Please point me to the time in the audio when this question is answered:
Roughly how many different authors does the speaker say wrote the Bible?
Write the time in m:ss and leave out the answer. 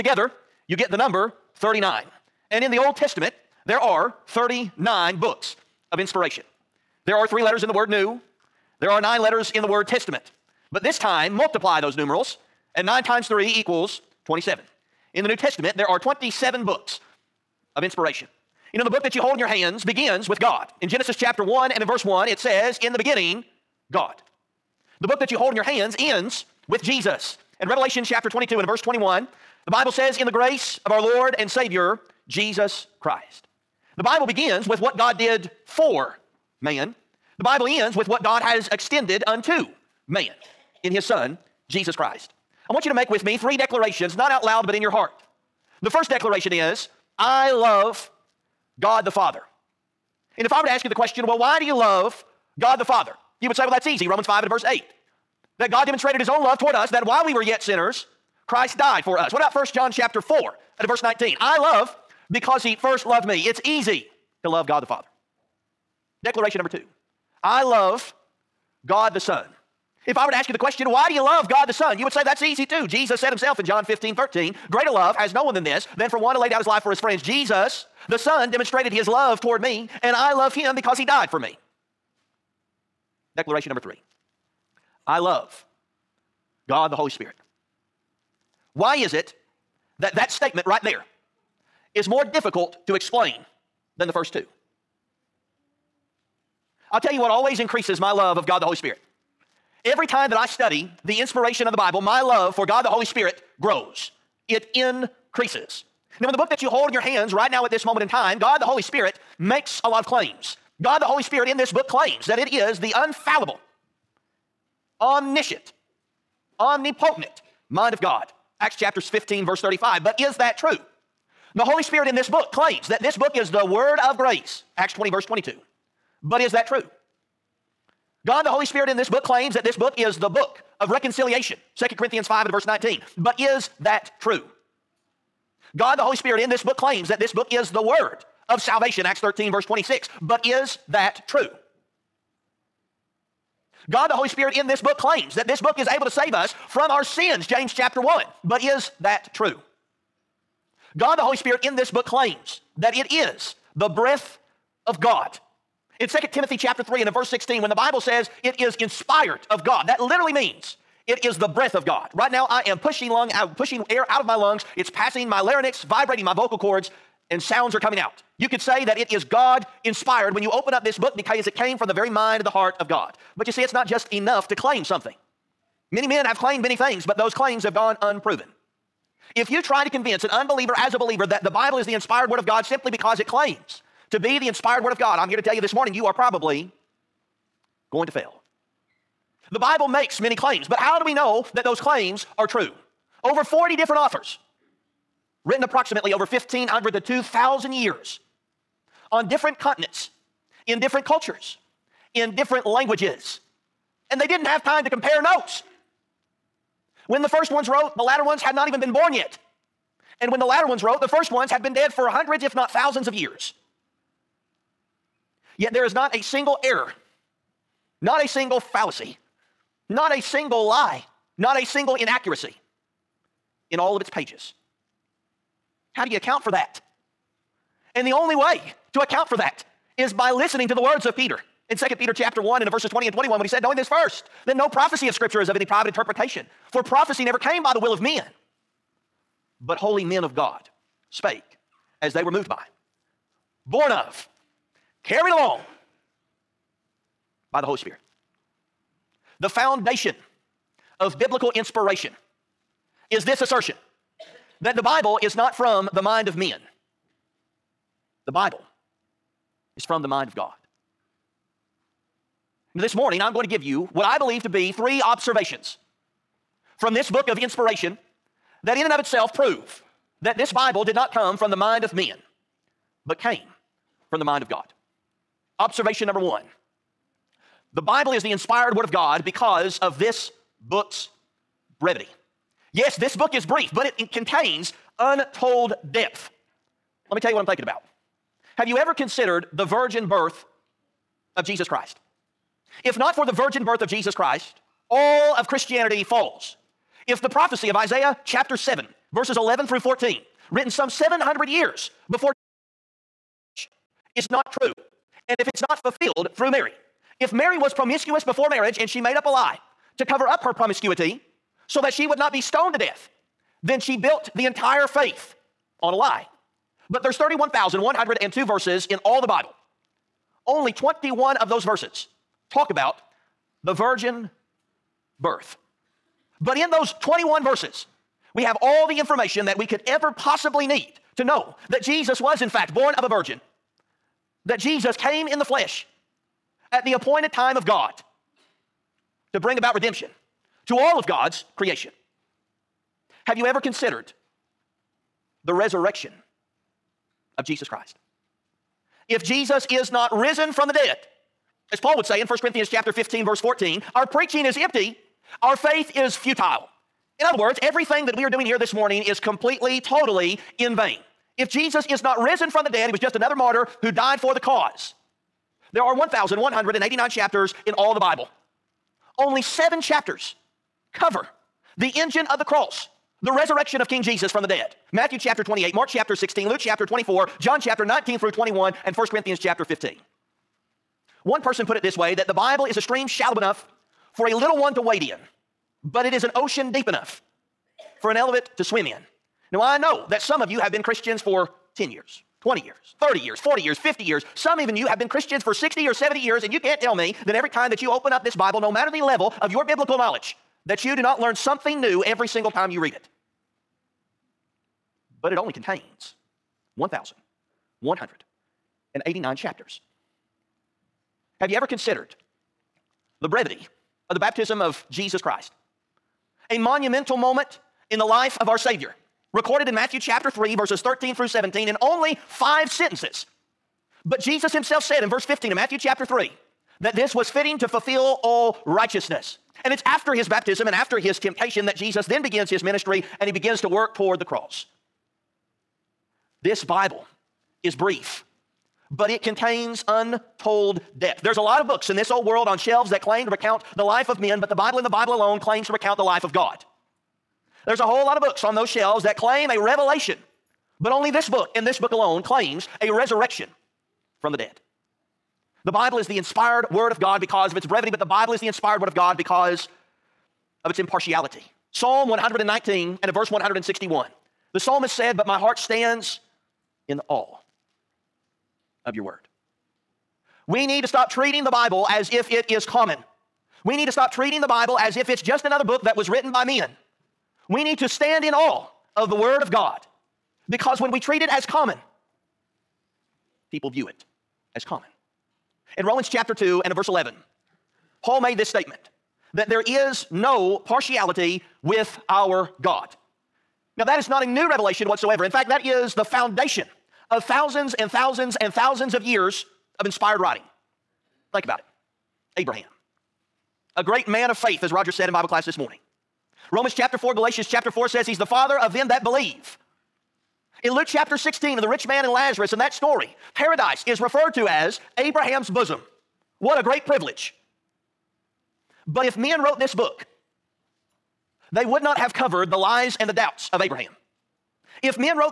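3:13.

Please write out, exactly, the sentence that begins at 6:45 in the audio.
But it only contains 1,189 chapters.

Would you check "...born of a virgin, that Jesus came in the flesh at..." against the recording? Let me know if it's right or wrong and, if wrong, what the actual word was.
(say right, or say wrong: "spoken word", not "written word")
right.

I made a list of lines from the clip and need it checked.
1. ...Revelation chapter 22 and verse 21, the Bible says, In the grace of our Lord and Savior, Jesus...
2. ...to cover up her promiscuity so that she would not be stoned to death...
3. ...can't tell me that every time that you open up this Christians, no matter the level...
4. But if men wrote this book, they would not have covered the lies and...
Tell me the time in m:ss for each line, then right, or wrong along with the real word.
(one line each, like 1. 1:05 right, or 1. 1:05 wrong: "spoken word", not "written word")
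1. 0:27 right
2. 5:09 right
3. 6:36 wrong: "Bible", not "Christians"
4. 8:38 right.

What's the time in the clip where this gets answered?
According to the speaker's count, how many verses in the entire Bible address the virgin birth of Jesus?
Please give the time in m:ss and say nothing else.
5:20.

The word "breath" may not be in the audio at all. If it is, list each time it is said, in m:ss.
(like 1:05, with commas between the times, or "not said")
2:33, 2:41.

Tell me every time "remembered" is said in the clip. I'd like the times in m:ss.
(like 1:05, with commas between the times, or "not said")
not said.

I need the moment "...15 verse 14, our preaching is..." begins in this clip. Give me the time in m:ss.
5:52.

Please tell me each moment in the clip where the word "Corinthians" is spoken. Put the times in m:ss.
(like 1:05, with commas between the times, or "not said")
2:11, 5:52, 6:19.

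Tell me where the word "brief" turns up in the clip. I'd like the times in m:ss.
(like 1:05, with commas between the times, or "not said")
4:43, 7:17.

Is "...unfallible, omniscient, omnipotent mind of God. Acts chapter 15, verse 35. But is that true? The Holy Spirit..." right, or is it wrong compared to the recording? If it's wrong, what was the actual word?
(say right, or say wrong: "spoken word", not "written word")
right.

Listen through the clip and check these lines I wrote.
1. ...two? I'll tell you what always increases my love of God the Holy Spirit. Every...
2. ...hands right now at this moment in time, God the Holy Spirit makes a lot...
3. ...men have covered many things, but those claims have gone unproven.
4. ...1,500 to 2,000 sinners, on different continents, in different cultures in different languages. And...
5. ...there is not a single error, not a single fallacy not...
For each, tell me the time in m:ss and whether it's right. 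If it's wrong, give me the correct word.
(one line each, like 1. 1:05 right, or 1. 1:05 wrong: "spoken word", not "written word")
1. 1:34 right
2. 1:47 right
3. 2:56 wrong: "claimed", not "covered"
4. 3:16 wrong: "years", not "sinners"
5. 3:35 right.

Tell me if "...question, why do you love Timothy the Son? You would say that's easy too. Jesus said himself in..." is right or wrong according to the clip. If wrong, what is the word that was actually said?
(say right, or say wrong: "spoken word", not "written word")
wrong: "God", not "Timothy".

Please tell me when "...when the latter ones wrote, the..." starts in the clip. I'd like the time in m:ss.
3:30.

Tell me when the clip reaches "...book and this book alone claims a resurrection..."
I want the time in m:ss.
7:31.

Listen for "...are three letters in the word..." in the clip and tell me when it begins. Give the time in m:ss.
0:07.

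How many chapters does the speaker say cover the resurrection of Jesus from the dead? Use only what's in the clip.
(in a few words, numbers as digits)
seven.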